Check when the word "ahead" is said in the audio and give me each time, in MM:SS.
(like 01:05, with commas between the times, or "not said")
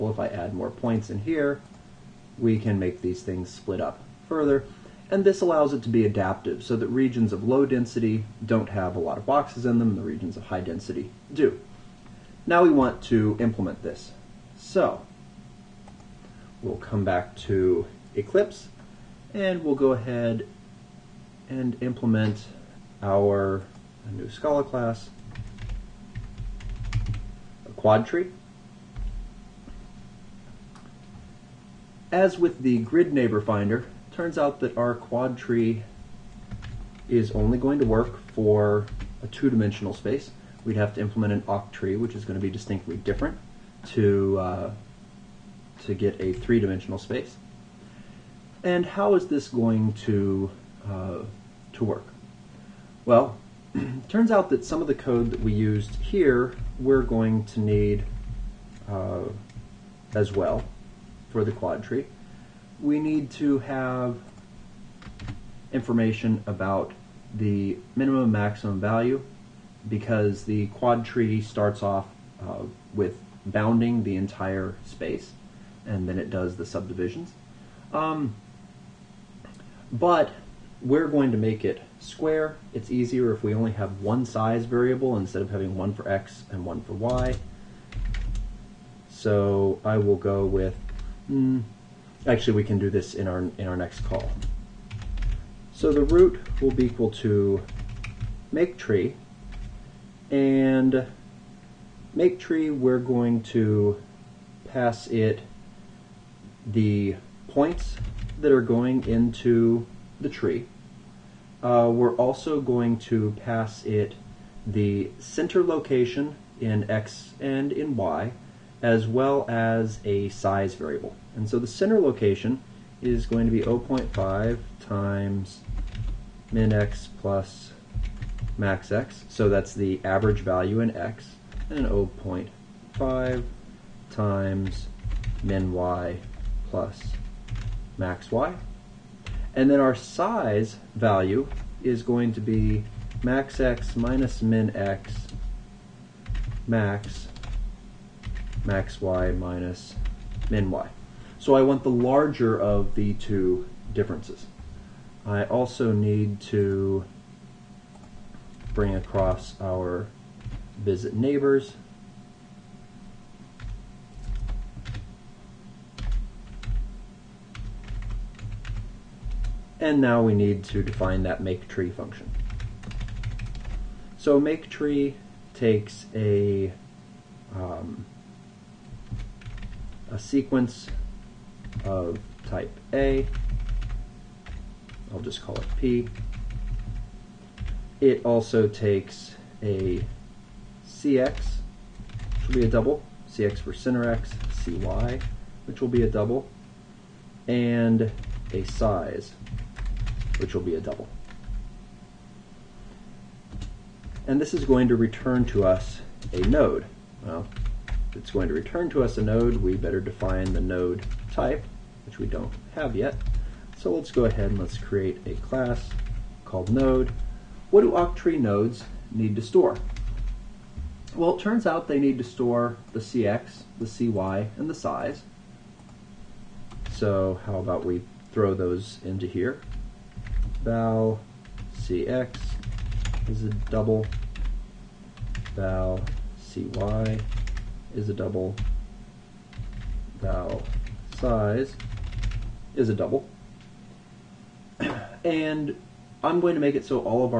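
00:19, 03:34.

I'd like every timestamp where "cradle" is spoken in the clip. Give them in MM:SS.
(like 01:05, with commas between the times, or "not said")
not said.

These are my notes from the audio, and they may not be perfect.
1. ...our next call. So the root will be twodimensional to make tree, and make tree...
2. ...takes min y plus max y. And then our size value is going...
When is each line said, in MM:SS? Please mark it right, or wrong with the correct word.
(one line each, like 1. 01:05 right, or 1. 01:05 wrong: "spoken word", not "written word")
1. 01:33 wrong: "equal", not "twodimensional"
2. 02:14 wrong: "times", not "takes".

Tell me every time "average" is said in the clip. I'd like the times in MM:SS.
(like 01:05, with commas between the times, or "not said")
02:10.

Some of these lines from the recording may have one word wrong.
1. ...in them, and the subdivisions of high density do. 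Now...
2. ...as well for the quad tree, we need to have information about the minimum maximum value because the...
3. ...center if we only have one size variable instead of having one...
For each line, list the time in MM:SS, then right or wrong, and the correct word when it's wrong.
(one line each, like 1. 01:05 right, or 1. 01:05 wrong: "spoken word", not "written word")
1. 00:09 wrong: "regions", not "subdivisions"
2. 01:00 right
3. 01:22 wrong: "easier", not "center".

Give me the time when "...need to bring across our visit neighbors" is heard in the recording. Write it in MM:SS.
02:35.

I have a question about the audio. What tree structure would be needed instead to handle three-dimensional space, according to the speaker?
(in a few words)
Oct tree.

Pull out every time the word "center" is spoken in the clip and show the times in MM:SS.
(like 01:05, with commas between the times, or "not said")
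01:55, 02:01.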